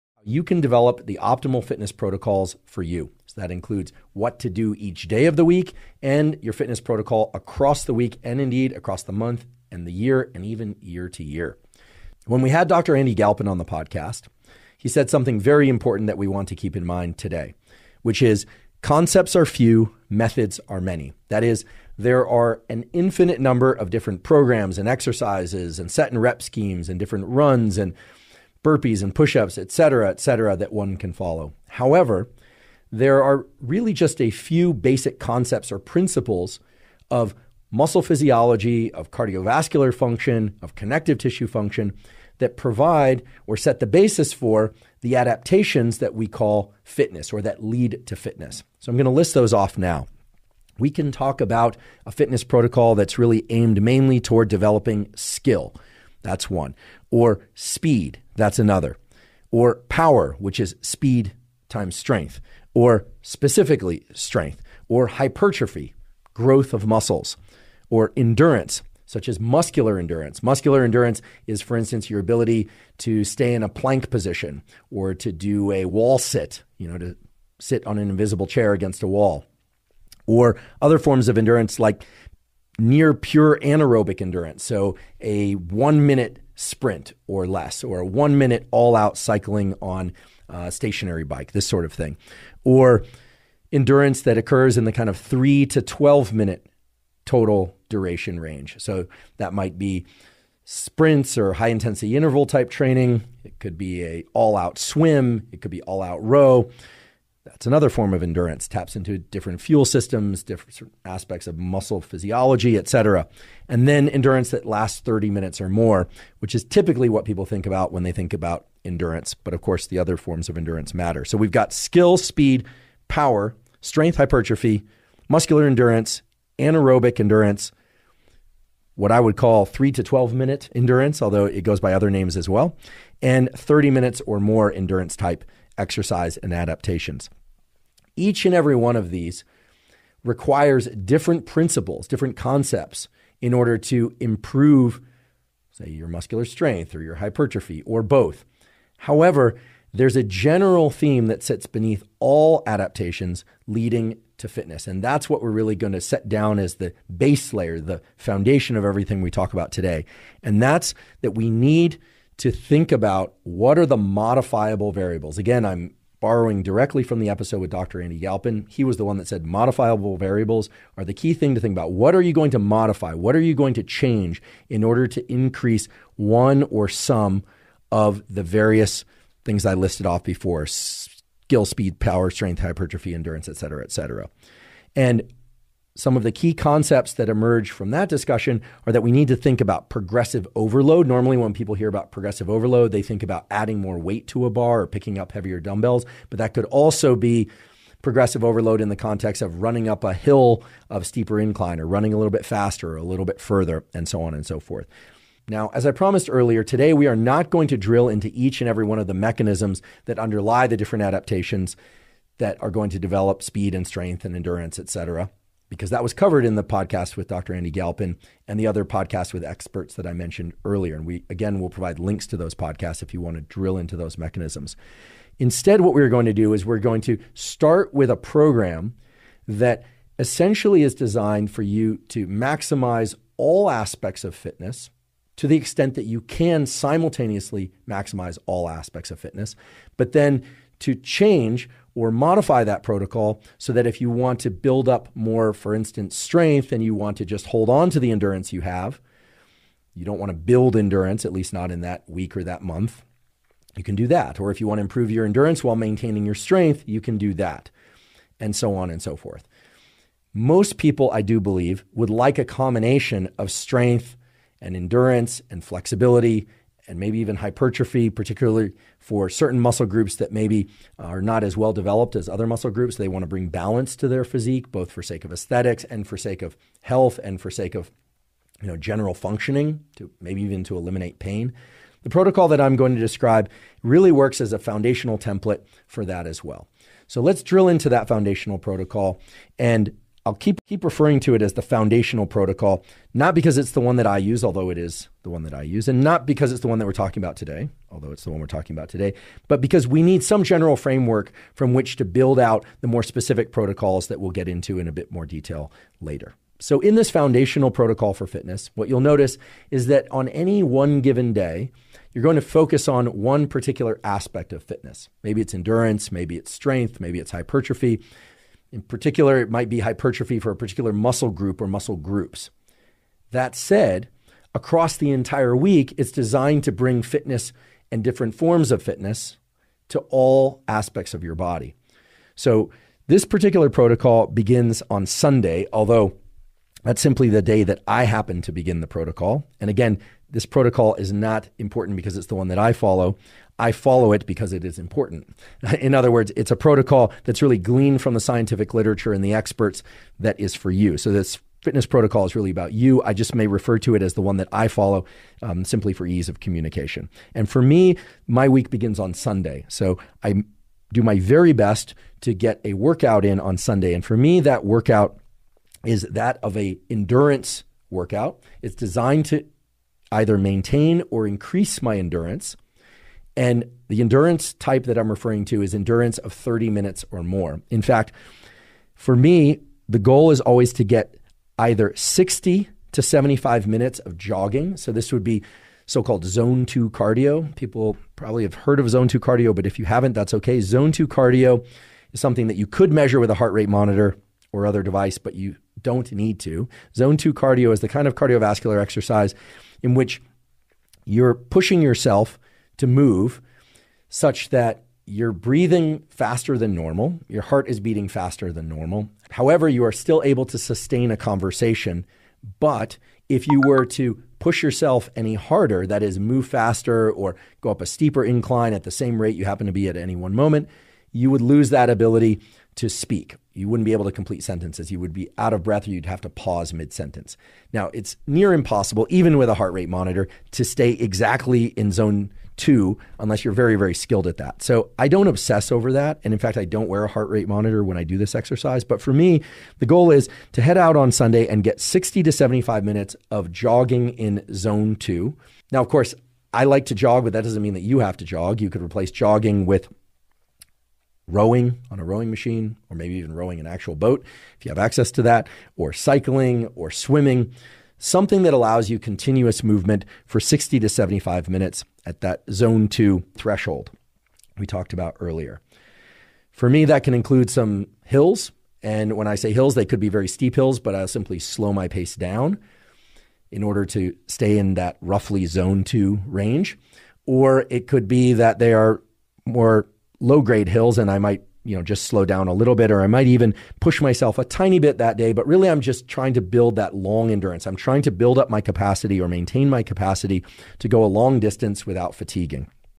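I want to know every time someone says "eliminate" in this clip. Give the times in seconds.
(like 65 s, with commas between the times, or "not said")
280 s.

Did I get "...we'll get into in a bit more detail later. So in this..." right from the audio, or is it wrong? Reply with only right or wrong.
right.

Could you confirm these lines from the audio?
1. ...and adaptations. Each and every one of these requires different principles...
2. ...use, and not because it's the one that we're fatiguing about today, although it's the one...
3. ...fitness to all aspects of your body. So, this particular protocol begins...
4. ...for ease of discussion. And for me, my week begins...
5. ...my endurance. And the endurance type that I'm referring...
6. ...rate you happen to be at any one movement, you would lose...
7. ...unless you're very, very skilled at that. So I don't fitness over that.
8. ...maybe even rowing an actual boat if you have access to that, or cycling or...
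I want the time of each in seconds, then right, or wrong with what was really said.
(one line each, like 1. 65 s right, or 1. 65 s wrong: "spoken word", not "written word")
1. 136 s right
2. 295 s wrong: "talking", not "fatiguing"
3. 328 s right
4. 355 s wrong: "communication", not "discussion"
5. 371 s right
6. 419 s wrong: "moment", not "movement"
7. 433 s wrong: "obsess", not "fitness"
8. 452 s right.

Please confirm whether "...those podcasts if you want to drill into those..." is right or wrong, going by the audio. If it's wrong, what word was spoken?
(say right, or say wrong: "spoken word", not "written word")
right.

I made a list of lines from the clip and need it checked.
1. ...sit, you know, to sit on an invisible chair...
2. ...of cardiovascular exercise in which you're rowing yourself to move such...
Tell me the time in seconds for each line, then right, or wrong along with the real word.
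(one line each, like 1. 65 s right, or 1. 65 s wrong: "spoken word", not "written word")
1. 76 s right
2. 398 s wrong: "pushing", not "rowing".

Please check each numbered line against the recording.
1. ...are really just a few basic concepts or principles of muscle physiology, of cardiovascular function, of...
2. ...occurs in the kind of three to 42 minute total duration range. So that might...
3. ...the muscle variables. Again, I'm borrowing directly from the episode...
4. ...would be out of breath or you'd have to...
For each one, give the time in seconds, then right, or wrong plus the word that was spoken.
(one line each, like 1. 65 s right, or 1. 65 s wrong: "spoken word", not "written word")
1. 33 s right
2. 94 s wrong: "12", not "42"
3. 163 s wrong: "modifiable", not "muscle"
4. 425 s right.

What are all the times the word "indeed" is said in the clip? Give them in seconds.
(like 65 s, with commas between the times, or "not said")
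8 s.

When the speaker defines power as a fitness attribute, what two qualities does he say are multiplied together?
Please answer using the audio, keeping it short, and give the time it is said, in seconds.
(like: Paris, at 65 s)
speed times strength, at 60 s.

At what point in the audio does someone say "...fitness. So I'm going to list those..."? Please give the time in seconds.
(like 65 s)
48 s.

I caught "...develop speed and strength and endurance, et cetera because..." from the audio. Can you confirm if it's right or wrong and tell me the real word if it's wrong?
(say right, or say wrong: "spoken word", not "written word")
right.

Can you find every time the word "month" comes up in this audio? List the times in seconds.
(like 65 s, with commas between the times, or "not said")
9 s, 252 s.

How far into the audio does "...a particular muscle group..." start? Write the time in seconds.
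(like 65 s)
320 s.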